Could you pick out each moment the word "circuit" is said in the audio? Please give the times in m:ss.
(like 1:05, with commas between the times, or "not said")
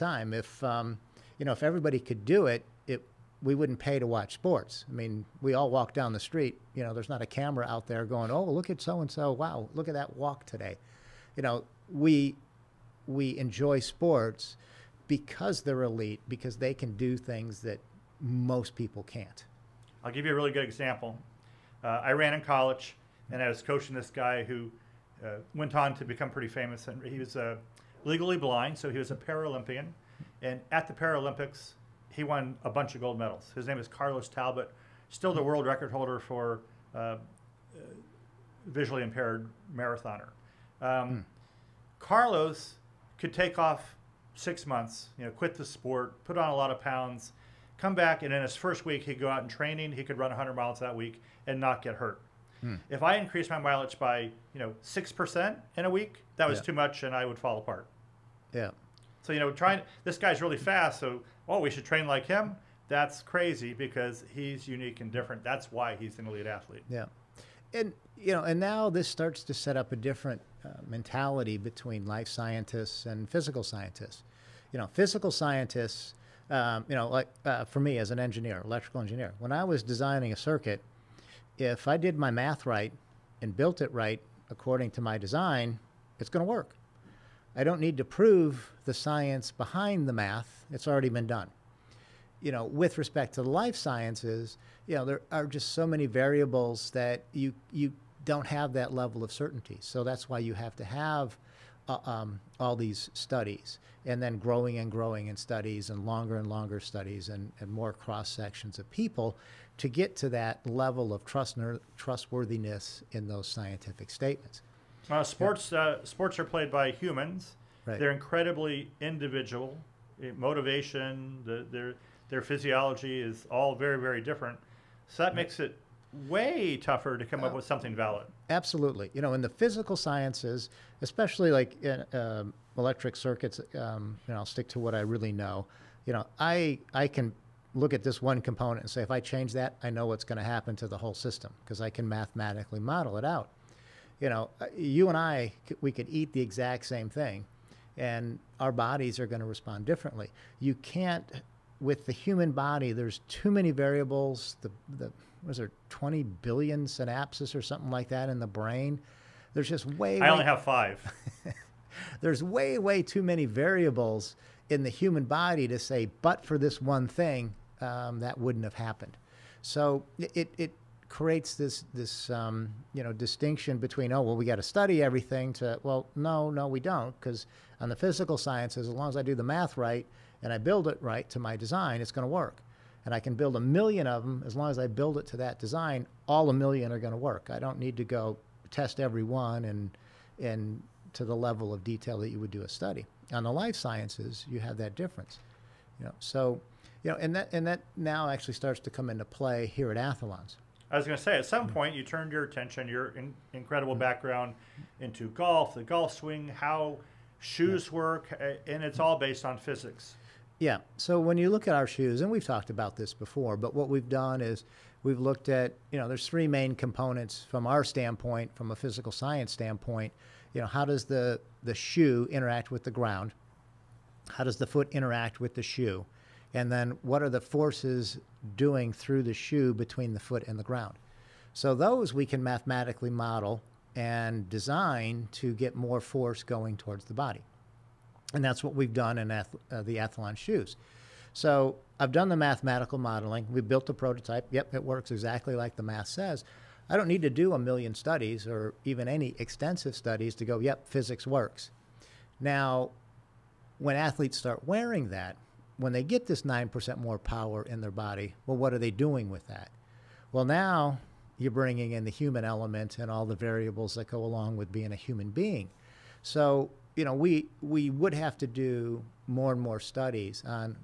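1:20, 2:13.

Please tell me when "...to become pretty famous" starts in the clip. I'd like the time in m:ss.
0:25.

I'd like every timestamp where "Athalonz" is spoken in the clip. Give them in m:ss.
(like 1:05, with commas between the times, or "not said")
3:19, 3:59.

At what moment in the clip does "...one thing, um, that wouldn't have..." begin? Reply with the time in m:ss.
2:46.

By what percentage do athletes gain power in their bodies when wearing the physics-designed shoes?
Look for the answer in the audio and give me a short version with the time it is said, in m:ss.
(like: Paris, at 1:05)
9%, at 4:16.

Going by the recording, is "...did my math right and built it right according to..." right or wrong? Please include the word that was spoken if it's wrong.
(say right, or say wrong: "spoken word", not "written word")
right.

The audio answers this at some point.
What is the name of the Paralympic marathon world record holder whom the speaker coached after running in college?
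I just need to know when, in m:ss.
0:33.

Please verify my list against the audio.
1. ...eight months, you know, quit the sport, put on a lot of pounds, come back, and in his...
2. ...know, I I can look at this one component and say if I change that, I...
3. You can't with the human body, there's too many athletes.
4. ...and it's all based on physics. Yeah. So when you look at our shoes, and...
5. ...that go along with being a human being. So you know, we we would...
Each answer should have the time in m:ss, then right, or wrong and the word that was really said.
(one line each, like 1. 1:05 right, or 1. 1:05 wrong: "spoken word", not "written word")
1. 0:44 wrong: "six", not "eight"
2. 2:16 right
3. 2:30 wrong: "variables", not "athletes"
4. 3:28 right
5. 4:23 right.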